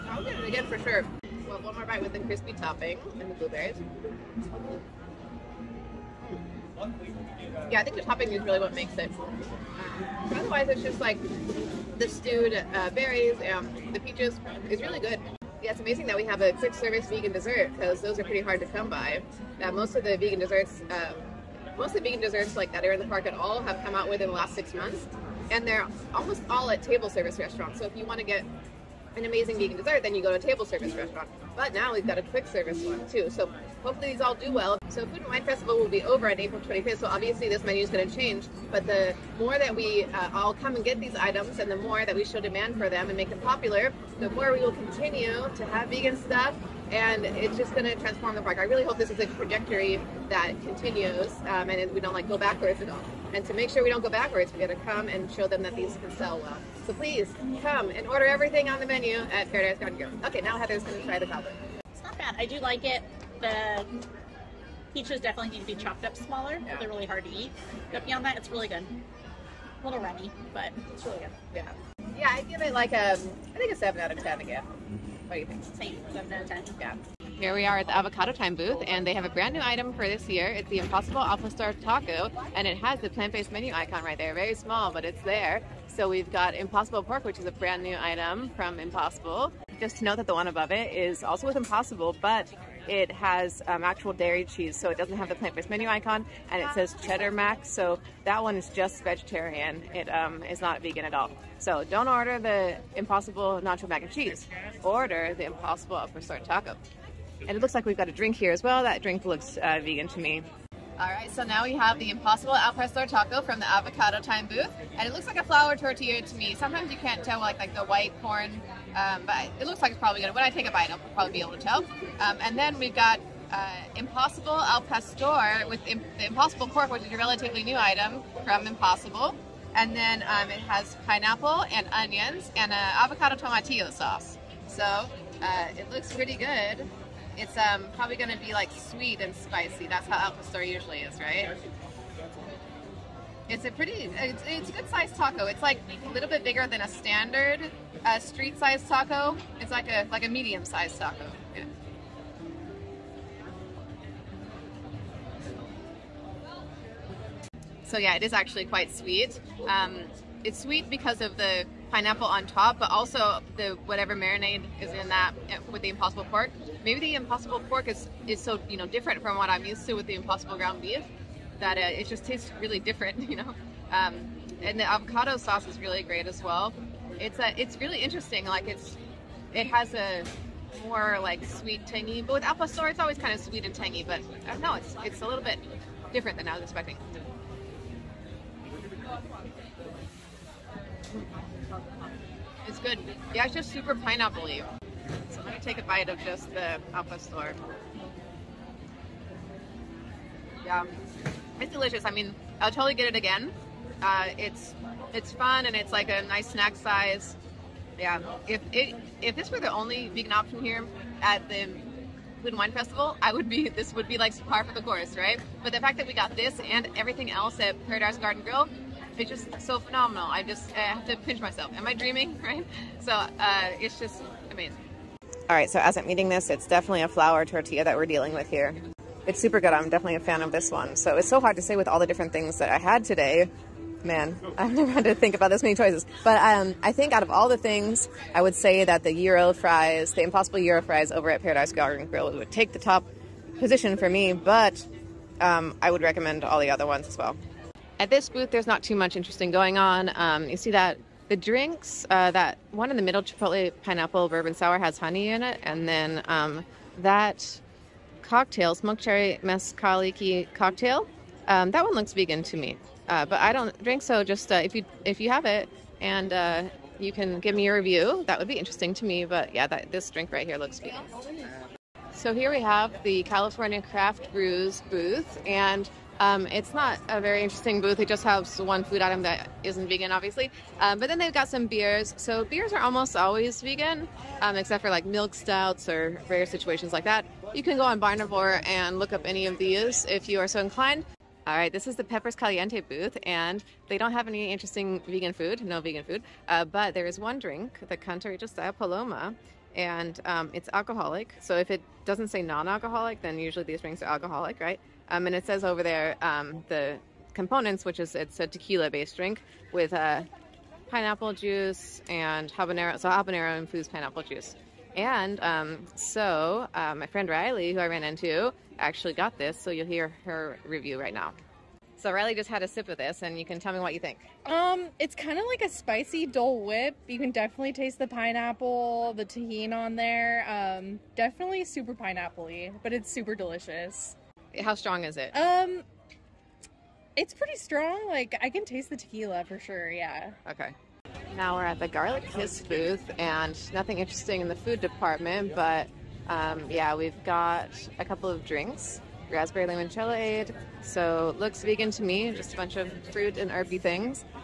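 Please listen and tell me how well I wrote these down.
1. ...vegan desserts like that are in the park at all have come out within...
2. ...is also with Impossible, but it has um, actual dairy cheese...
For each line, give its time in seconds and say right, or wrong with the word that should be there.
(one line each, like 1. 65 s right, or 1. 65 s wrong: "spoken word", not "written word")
1. 22 s right
2. 90 s right.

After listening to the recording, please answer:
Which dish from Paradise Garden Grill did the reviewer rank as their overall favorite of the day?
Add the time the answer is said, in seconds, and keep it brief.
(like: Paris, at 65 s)
Impossible Gyro fries, at 240 s.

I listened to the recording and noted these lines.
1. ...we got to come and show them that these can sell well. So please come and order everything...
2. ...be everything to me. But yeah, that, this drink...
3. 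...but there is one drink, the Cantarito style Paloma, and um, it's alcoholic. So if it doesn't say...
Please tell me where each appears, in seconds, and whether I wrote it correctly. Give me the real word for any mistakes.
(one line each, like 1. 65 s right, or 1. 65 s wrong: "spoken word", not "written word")
1. 54 s right
2. 268 s wrong: "interesting", not "everything"
3. 296 s right.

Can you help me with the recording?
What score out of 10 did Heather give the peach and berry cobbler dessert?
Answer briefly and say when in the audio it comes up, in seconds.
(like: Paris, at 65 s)
7, at 73 s.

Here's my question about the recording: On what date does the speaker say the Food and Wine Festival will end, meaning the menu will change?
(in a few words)
April 25th.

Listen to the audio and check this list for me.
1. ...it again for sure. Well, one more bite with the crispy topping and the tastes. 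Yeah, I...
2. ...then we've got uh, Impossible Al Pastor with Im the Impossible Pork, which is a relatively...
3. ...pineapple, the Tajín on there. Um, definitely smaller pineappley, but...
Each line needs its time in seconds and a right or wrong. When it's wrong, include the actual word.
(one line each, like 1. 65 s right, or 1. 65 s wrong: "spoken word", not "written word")
1. 0 s wrong: "blueberries", not "tastes"
2. 122 s right
3. 328 s wrong: "super", not "smaller".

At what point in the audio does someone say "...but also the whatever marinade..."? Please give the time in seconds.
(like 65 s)
162 s.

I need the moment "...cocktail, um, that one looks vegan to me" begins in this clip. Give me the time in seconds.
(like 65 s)
260 s.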